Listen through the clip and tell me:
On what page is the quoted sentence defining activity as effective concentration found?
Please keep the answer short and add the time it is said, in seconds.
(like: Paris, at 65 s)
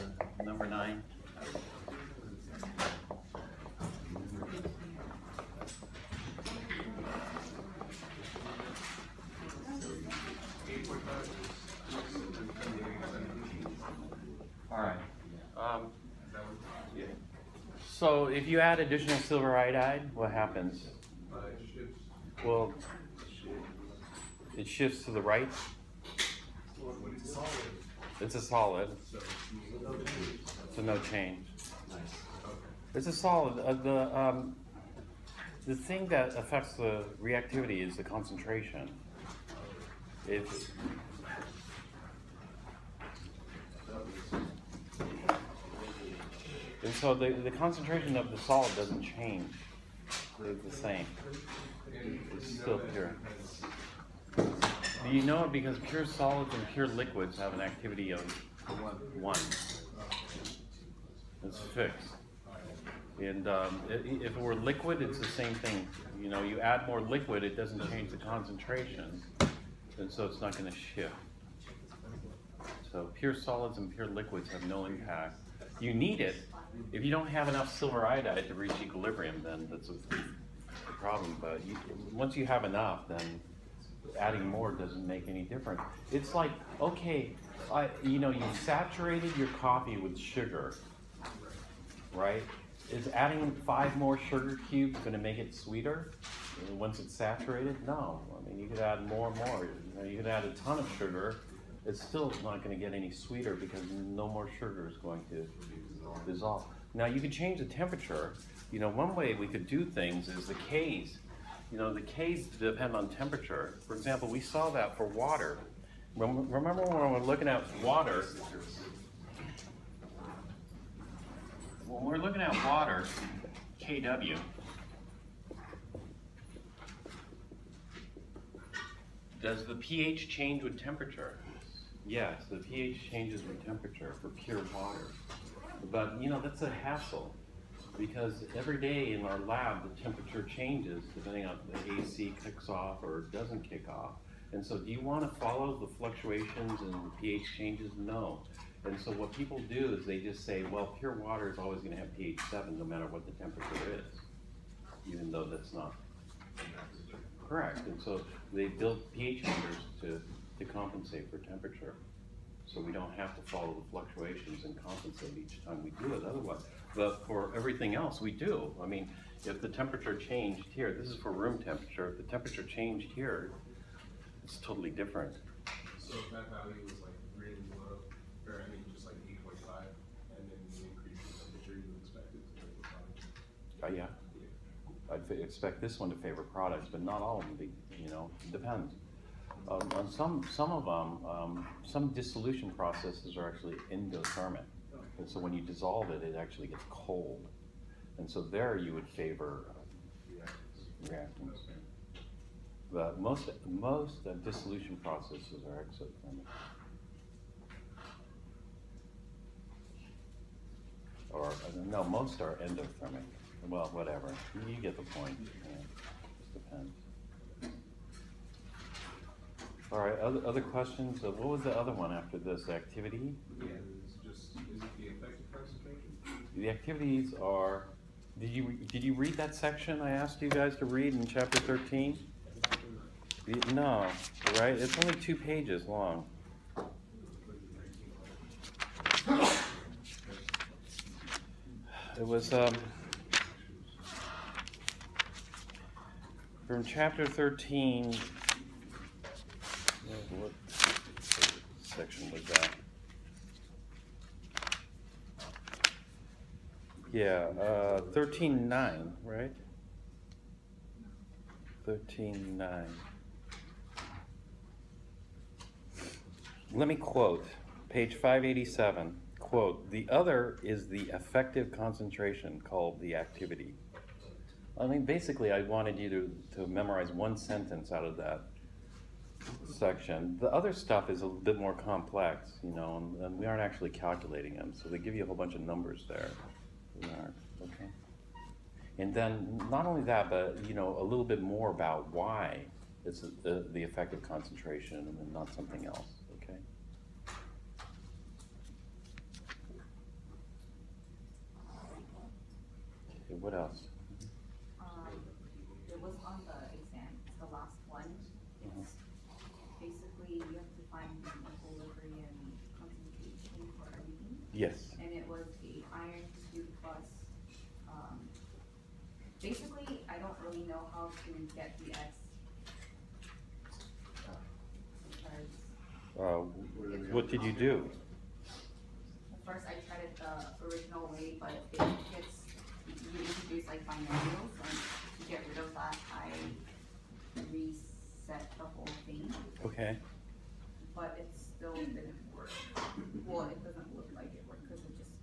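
587, at 268 s.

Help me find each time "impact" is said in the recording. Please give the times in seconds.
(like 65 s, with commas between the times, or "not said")
74 s.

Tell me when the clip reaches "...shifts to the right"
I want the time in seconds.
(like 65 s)
24 s.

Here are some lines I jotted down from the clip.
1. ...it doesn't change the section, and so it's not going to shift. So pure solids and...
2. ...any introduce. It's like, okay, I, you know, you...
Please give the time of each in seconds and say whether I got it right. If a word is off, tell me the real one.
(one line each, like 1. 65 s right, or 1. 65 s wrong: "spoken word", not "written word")
1. 67 s wrong: "concentration", not "section"
2. 85 s wrong: "difference", not "introduce".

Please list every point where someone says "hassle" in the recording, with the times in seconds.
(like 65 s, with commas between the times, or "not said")
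136 s.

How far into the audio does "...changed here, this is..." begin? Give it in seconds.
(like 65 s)
170 s.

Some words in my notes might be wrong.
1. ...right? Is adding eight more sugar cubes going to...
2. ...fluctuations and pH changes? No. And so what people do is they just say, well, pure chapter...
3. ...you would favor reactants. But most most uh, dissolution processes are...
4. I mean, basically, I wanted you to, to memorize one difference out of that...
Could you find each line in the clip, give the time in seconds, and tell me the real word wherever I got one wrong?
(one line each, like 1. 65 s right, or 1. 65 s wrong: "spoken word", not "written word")
1. 92 s wrong: "five", not "eight"
2. 145 s wrong: "water", not "chapter"
3. 198 s right
4. 274 s wrong: "sentence", not "difference".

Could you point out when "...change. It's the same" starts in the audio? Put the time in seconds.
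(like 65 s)
49 s.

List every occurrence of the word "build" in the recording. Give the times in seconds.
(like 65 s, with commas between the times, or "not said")
158 s.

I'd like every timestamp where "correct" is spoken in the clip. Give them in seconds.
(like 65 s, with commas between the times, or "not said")
157 s.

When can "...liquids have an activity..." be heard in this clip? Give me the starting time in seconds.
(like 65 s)
56 s.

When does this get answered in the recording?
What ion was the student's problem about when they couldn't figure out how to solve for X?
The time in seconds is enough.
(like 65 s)
315 s.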